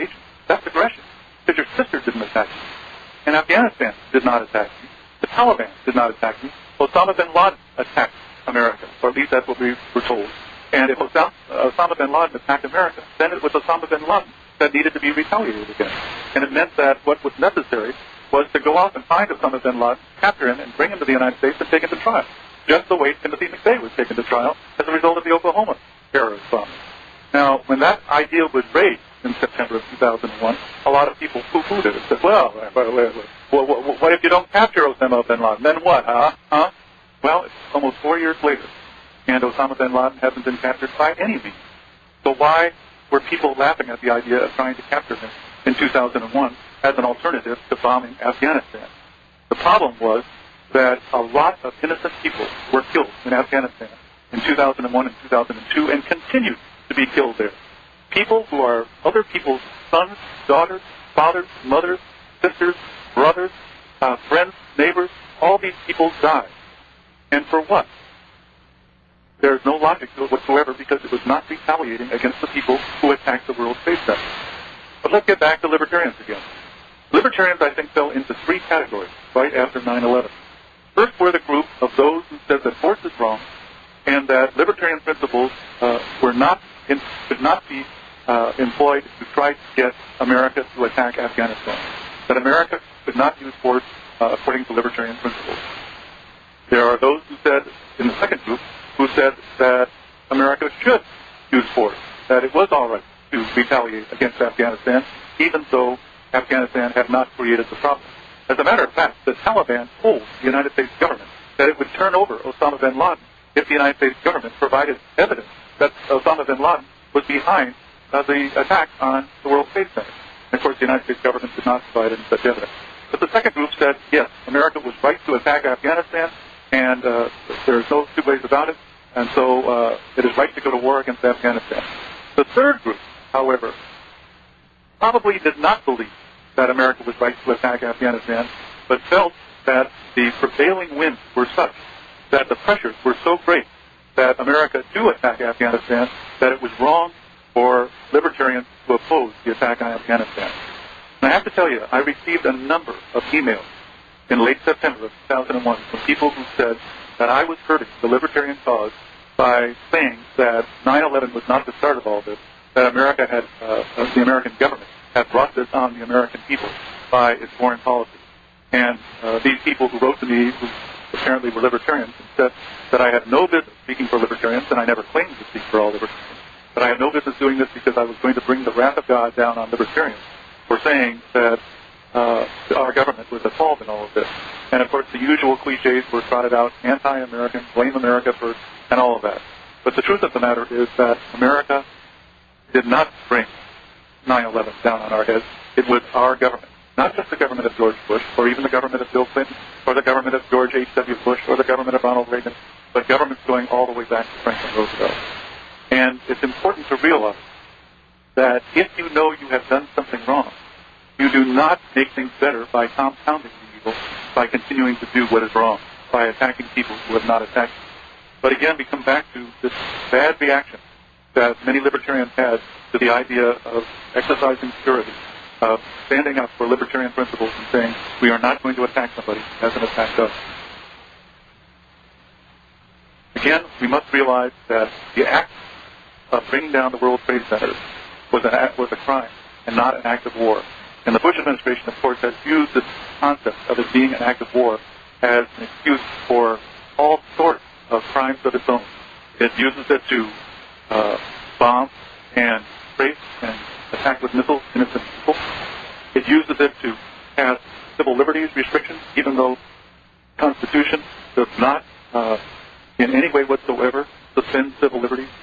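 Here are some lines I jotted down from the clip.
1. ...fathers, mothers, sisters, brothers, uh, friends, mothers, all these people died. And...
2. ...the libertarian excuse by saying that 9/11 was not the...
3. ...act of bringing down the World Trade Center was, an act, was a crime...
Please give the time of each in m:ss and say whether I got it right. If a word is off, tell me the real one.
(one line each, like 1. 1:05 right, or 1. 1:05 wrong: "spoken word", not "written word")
1. 1:01 wrong: "neighbors", not "mothers"
2. 2:38 wrong: "cause", not "excuse"
3. 3:55 right.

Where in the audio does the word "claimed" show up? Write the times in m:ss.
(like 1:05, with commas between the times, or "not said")
2:55.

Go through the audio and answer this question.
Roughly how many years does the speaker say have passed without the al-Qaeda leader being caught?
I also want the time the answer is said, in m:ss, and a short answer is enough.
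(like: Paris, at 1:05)
4, at 0:37.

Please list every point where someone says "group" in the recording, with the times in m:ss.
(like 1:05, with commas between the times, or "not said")
1:21, 1:38, 2:03, 2:12.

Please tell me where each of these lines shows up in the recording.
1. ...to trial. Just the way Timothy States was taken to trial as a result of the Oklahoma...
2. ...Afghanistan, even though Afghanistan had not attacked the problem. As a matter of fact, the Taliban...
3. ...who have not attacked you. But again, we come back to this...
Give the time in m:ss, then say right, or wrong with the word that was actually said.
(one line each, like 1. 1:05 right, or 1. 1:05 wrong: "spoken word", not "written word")
1. 0:21 wrong: "McVeigh", not "States"
2. 1:44 wrong: "created", not "attacked"
3. 3:36 right.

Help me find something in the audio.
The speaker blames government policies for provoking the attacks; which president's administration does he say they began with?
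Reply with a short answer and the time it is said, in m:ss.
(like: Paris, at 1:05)
Franklin Roosevelt, at 3:24.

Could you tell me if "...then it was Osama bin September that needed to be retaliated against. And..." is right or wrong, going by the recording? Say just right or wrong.
wrong.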